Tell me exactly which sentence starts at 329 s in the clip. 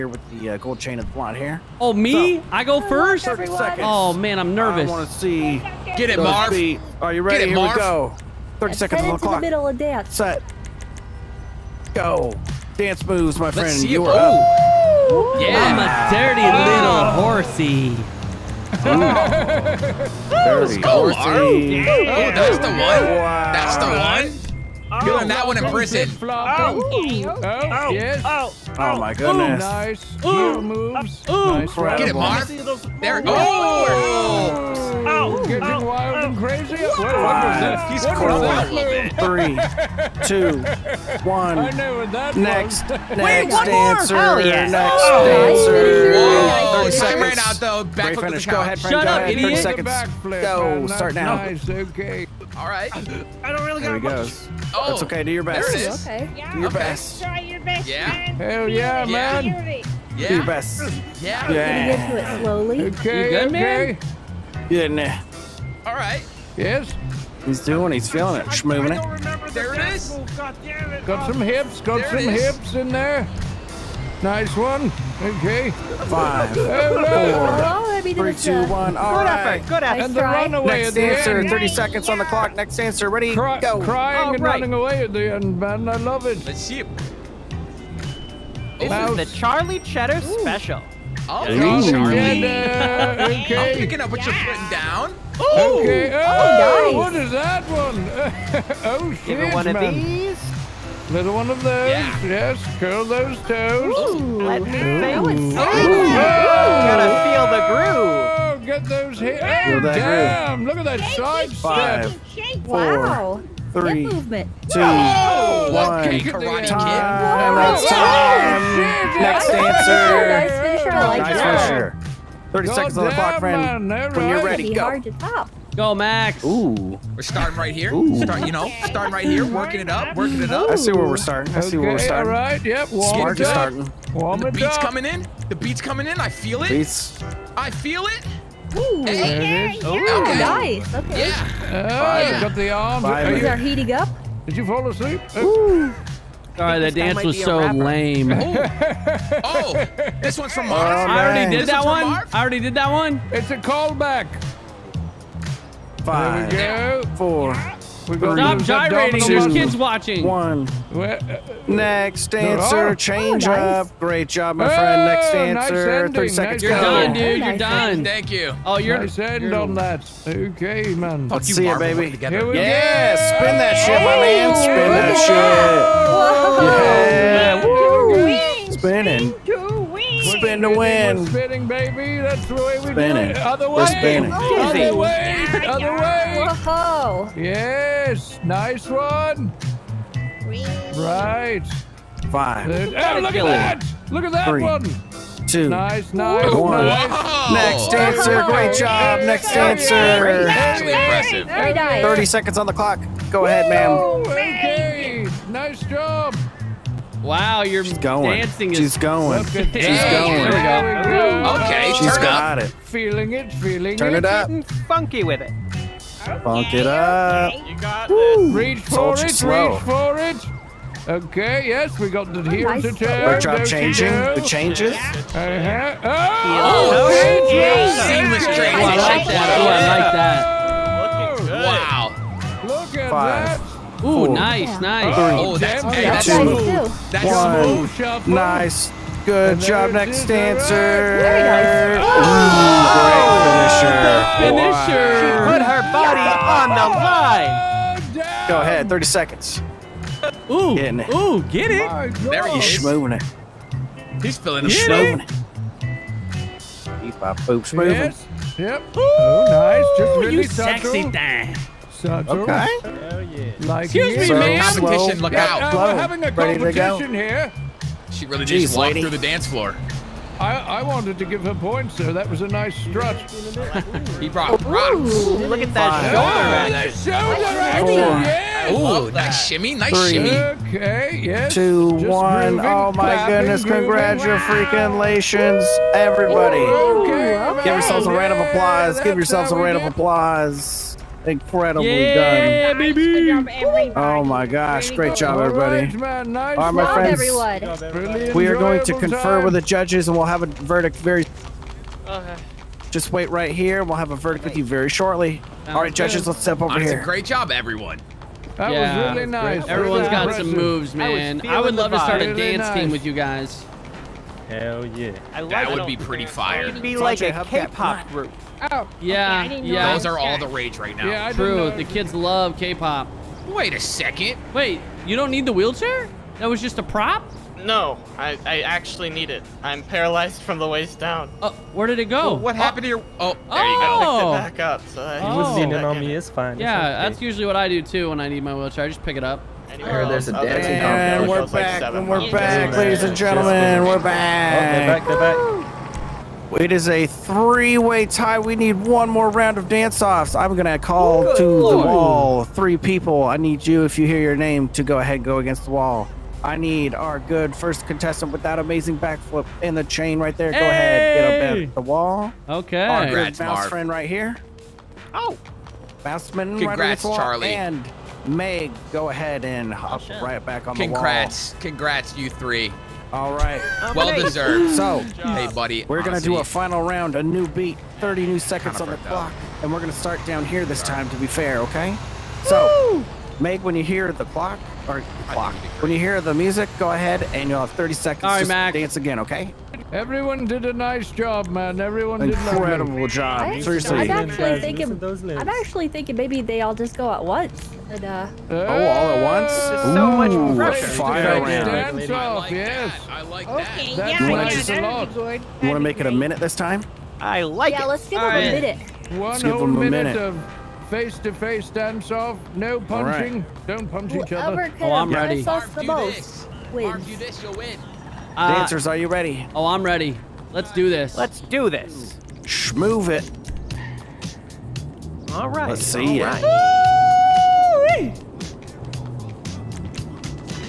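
I'm paralyzed from the waist down.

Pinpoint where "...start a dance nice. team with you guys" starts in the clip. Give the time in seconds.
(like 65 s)
311 s.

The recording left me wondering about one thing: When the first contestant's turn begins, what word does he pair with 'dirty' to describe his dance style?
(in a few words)
horsey.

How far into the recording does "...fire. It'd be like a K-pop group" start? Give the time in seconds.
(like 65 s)
316 s.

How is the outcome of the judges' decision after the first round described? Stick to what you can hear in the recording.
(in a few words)
Three-way tie.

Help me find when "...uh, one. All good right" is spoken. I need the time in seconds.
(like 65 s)
78 s.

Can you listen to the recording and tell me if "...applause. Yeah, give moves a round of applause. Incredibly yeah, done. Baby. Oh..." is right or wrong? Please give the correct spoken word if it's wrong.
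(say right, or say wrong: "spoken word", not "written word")
wrong: "yourselves", not "moves".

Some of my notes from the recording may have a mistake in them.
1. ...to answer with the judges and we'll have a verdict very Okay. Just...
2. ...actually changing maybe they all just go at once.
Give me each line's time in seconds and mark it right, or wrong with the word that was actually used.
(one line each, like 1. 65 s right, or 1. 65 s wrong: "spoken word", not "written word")
1. 298 s wrong: "confer", not "answer"
2. 395 s wrong: "thinking", not "changing".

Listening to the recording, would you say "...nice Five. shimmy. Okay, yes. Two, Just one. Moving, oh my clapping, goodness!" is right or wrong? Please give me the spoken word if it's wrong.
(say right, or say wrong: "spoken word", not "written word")
wrong: "Three", not "Five".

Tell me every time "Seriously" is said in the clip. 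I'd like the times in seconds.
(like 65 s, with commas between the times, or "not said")
393 s.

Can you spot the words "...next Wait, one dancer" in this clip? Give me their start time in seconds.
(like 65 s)
42 s.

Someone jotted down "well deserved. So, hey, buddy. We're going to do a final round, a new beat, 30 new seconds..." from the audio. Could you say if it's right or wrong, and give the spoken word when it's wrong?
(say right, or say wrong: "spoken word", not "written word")
right.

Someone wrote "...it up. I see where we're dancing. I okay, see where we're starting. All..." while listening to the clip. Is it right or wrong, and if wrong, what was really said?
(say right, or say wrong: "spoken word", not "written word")
wrong: "starting", not "dancing".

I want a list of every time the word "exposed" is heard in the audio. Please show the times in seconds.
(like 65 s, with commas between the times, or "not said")
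not said.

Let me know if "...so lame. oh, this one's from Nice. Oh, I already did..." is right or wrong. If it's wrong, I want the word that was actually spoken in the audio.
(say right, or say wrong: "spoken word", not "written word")
wrong: "Mark", not "Nice".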